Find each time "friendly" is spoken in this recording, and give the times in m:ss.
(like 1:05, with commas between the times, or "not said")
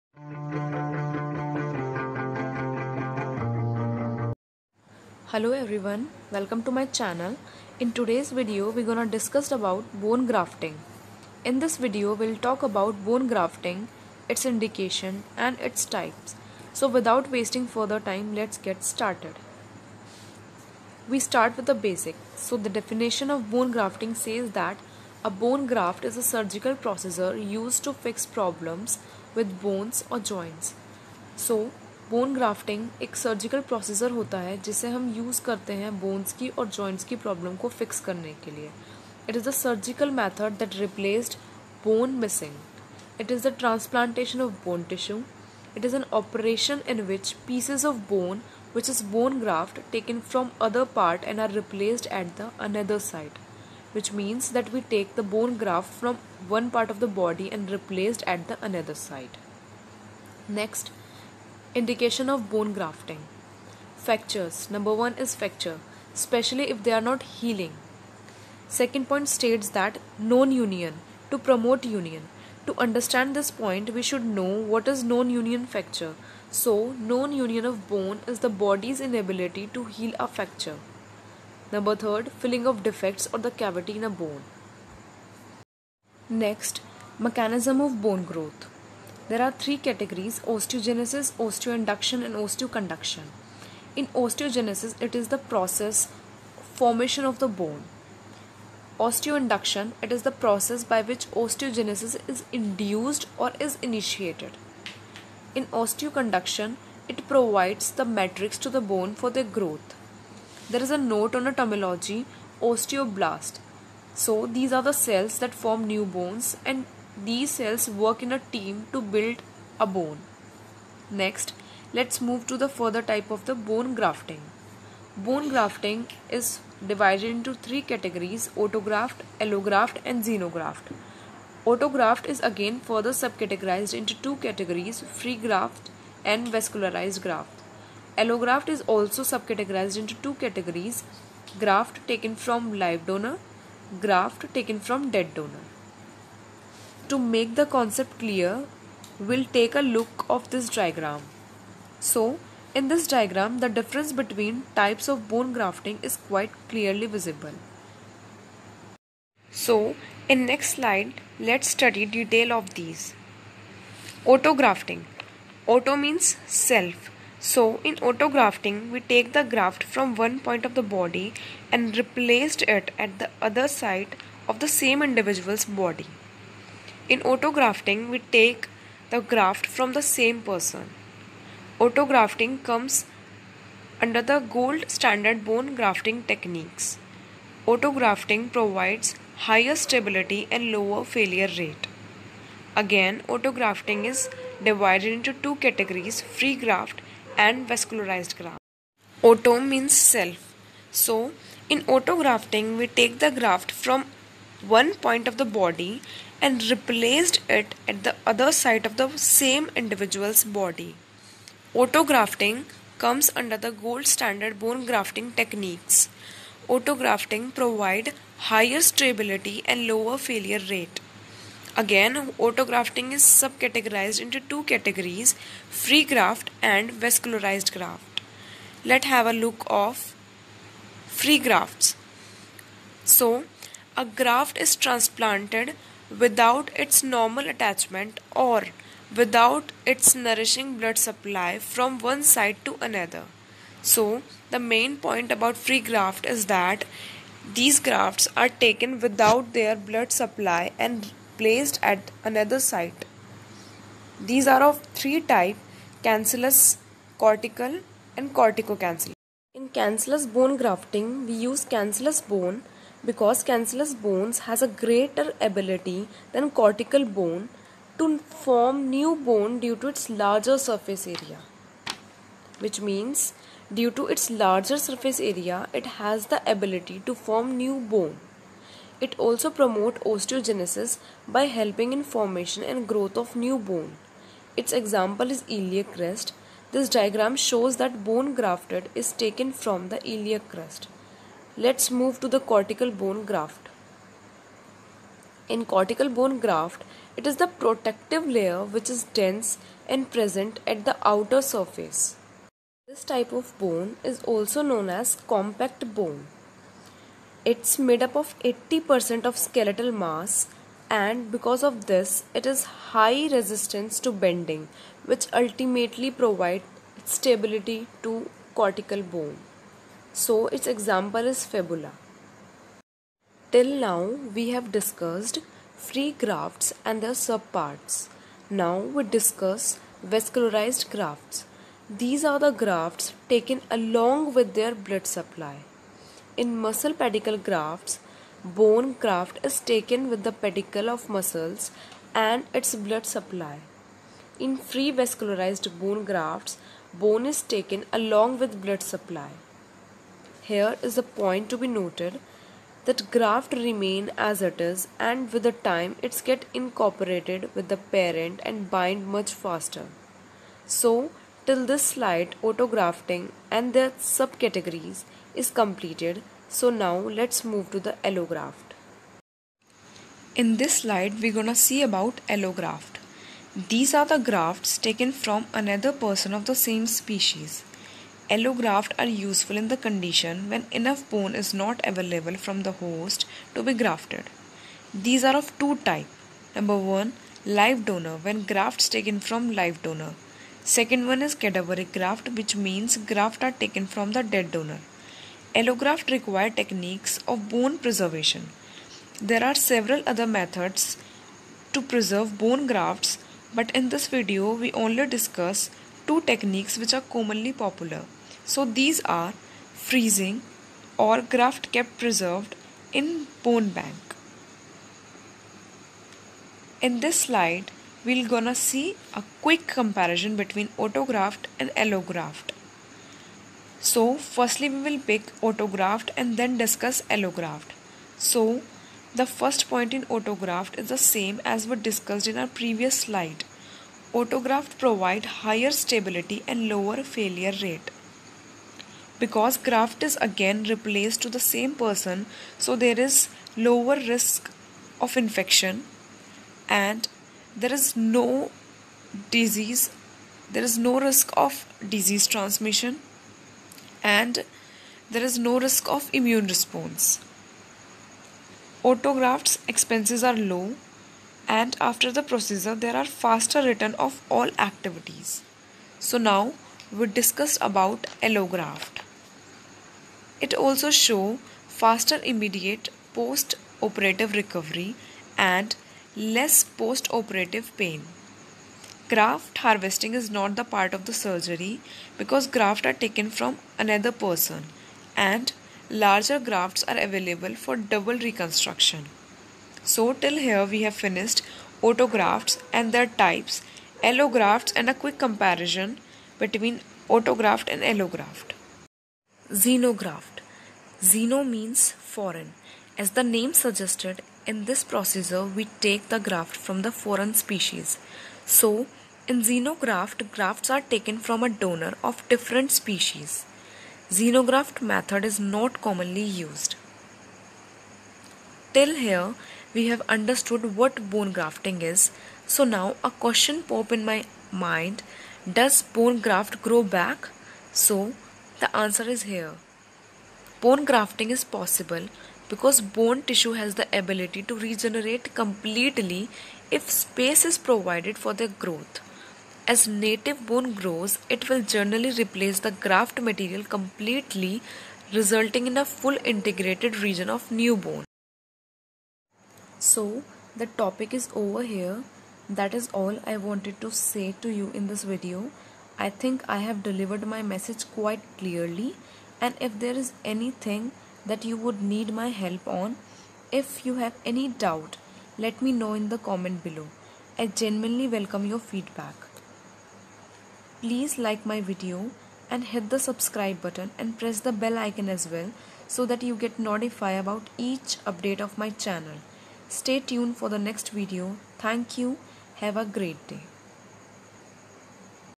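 not said.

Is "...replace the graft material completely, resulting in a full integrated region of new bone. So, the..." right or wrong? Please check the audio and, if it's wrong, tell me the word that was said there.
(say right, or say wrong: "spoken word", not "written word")
right.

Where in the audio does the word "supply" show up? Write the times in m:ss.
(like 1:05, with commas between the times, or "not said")
4:01, 4:10, 5:35, 5:43, 5:48.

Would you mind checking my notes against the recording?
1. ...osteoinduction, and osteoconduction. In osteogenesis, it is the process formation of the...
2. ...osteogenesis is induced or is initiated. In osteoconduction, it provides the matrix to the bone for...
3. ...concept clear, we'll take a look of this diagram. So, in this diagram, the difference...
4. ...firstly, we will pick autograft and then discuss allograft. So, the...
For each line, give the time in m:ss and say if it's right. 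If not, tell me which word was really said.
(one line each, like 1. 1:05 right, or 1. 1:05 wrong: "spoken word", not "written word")
1. 1:31 right
2. 1:41 right
3. 2:27 right
4. 7:04 right.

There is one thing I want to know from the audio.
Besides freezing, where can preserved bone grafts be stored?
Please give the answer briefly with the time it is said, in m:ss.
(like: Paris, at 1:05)
Bone bank, at 6:53.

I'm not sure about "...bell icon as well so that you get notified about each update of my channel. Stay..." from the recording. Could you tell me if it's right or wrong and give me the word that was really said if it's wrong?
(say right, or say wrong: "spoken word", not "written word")
right.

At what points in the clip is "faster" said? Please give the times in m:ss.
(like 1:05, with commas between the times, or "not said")
5:59, 7:43, 7:51.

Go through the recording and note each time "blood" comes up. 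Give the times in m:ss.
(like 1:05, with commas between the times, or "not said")
4:00, 4:09, 5:34, 5:42, 5:48.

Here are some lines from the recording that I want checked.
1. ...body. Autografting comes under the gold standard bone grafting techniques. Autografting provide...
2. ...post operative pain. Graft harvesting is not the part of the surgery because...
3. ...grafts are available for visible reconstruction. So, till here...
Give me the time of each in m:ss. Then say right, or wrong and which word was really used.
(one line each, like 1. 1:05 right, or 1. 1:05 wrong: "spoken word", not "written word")
1. 3:30 right
2. 7:56 right
3. 8:06 wrong: "double", not "visible".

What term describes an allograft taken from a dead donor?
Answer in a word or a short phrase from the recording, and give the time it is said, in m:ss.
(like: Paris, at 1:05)
Cadaveric graft, at 6:31.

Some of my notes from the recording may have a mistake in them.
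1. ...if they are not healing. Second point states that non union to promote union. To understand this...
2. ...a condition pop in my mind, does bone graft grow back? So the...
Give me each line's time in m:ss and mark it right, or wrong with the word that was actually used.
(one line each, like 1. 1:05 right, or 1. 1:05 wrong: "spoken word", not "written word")
1. 1:06 right
2. 8:43 wrong: "question", not "condition".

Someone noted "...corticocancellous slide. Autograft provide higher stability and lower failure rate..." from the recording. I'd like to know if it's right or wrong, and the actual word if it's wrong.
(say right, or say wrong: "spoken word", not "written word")
wrong: "previous", not "corticocancellous".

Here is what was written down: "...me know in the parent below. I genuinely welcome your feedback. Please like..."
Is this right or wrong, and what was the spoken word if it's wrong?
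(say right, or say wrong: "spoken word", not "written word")
wrong: "comment", not "parent".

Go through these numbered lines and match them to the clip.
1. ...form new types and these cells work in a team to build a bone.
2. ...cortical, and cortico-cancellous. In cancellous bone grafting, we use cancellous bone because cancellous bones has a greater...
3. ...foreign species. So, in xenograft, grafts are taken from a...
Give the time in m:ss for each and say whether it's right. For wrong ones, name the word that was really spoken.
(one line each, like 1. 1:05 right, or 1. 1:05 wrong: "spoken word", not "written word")
1. 1:55 wrong: "bones", not "types"
2. 4:17 right
3. 8:26 right.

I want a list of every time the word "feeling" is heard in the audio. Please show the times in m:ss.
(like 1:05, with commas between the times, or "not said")
not said.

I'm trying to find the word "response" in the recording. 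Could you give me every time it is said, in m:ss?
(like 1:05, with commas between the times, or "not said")
7:36.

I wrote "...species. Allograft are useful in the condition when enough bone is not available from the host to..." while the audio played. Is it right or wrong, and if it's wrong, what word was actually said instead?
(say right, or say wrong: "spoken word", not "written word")
right.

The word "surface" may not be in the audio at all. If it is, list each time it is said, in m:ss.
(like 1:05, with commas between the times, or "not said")
4:30, 4:34, 5:01.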